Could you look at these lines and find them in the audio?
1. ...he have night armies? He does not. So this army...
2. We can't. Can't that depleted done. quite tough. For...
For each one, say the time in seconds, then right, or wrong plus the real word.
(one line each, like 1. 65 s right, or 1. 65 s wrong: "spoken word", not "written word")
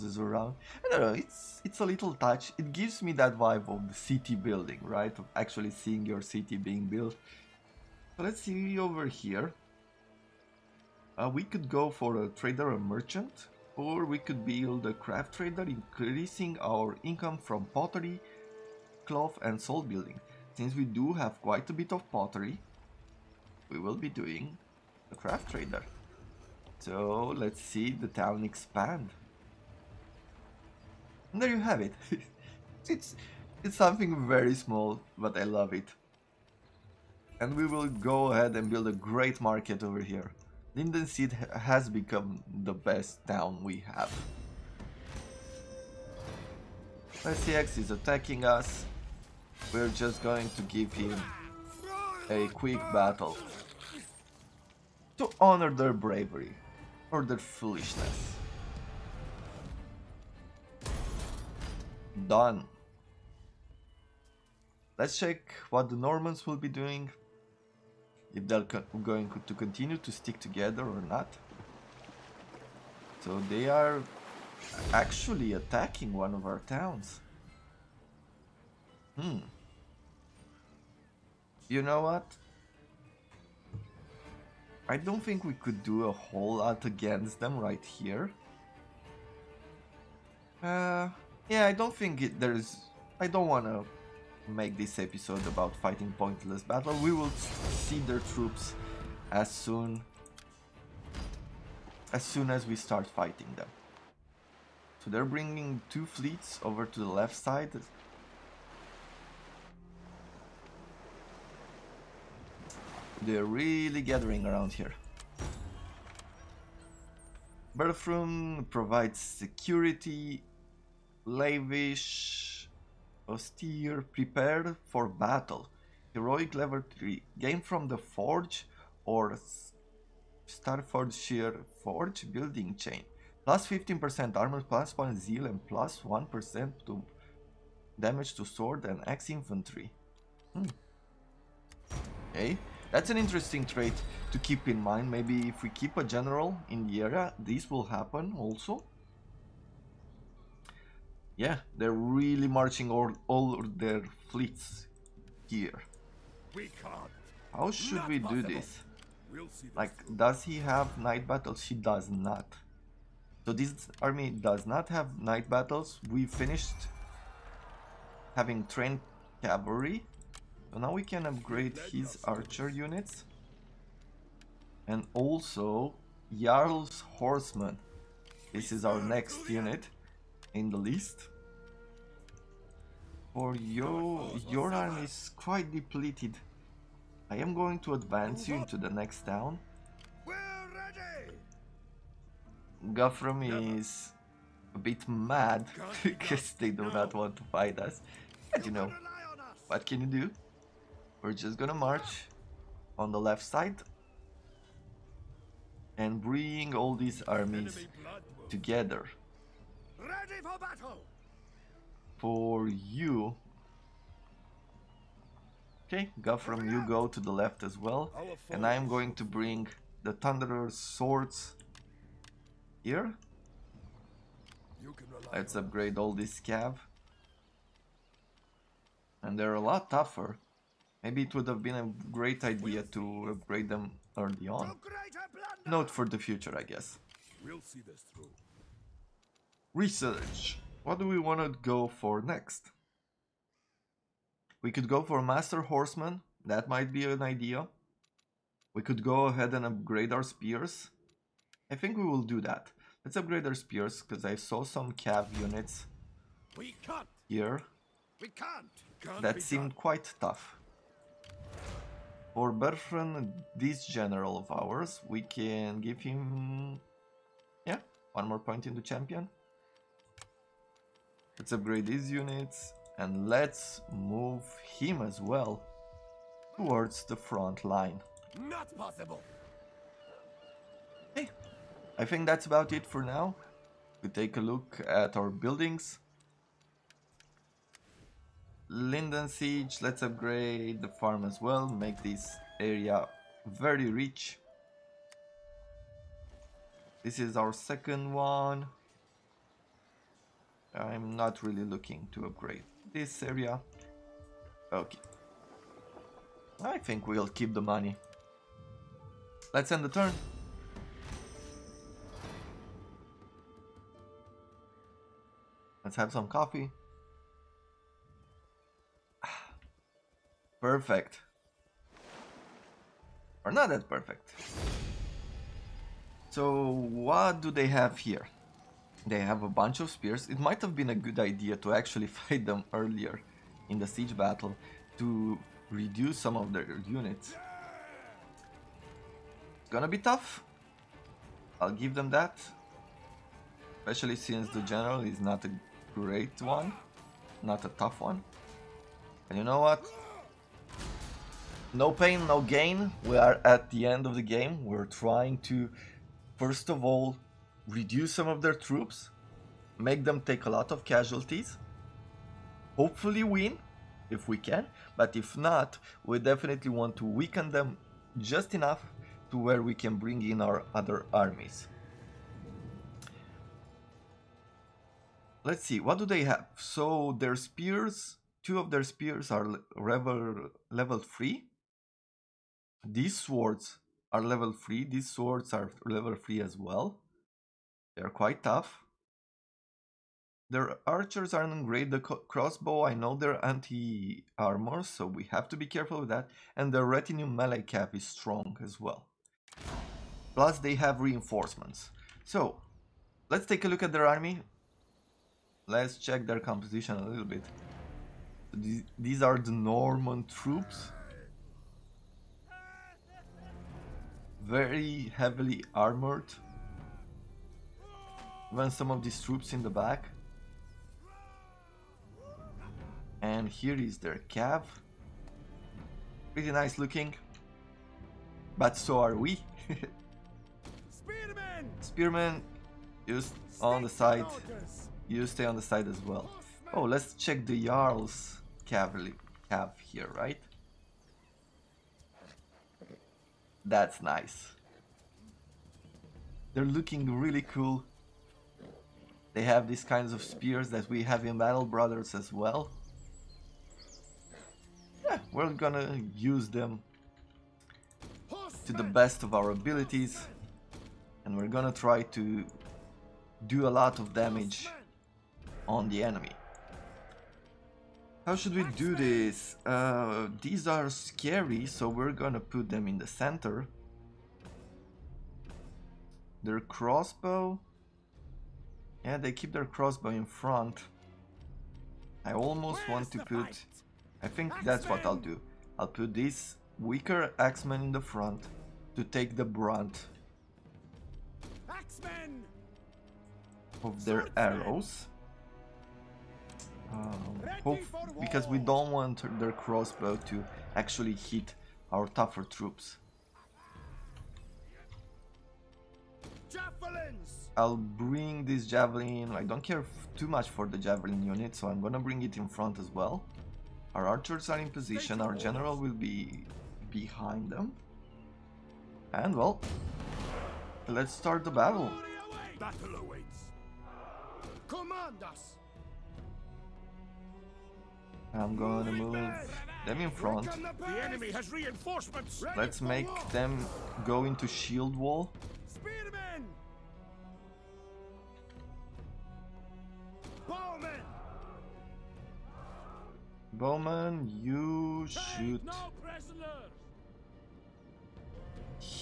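1. 160 s wrong: "battles", not "armies"
2. 258 s wrong: "seemed", not "depleted".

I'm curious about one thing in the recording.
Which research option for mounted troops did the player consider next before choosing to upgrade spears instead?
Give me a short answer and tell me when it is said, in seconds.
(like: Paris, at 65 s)
Master Horseman, at 245 s.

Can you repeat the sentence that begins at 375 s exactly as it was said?
Let's see, what do they have?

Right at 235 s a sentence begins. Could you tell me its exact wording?
Note for the future, I guess.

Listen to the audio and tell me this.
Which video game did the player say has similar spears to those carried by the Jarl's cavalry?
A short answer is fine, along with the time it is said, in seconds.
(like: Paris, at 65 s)
Battle Brothers, at 451 s.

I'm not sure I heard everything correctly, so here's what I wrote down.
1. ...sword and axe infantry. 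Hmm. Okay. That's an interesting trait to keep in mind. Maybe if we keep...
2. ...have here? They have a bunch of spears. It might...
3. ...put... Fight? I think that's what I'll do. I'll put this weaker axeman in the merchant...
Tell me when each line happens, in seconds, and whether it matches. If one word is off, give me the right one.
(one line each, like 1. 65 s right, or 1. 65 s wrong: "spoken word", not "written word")
1. 138 s right
2. 327 s right
3. 483 s wrong: "front", not "merchant".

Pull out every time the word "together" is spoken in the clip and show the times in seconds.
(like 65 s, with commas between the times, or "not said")
70 s, 208 s.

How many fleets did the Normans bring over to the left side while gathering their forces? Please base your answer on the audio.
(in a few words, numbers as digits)
2.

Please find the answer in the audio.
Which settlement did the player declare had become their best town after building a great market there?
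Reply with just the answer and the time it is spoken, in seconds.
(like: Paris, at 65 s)
Linden Seed, at 40 s.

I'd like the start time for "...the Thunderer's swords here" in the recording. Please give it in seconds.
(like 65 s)
220 s.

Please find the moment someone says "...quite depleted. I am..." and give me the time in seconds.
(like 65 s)
185 s.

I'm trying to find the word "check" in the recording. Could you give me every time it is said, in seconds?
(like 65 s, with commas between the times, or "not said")
65 s, 405 s, 437 s.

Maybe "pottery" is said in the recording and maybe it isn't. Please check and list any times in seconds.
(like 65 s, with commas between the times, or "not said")
17 s, 22 s.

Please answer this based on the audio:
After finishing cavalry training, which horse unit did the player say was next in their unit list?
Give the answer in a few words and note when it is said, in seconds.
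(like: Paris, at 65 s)
Jarl's Horseman, at 176 s.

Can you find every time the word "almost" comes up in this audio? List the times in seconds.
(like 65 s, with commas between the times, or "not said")
482 s.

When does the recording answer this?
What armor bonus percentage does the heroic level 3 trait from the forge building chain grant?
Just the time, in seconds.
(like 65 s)
133 s.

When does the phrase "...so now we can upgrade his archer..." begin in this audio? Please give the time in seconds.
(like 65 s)
170 s.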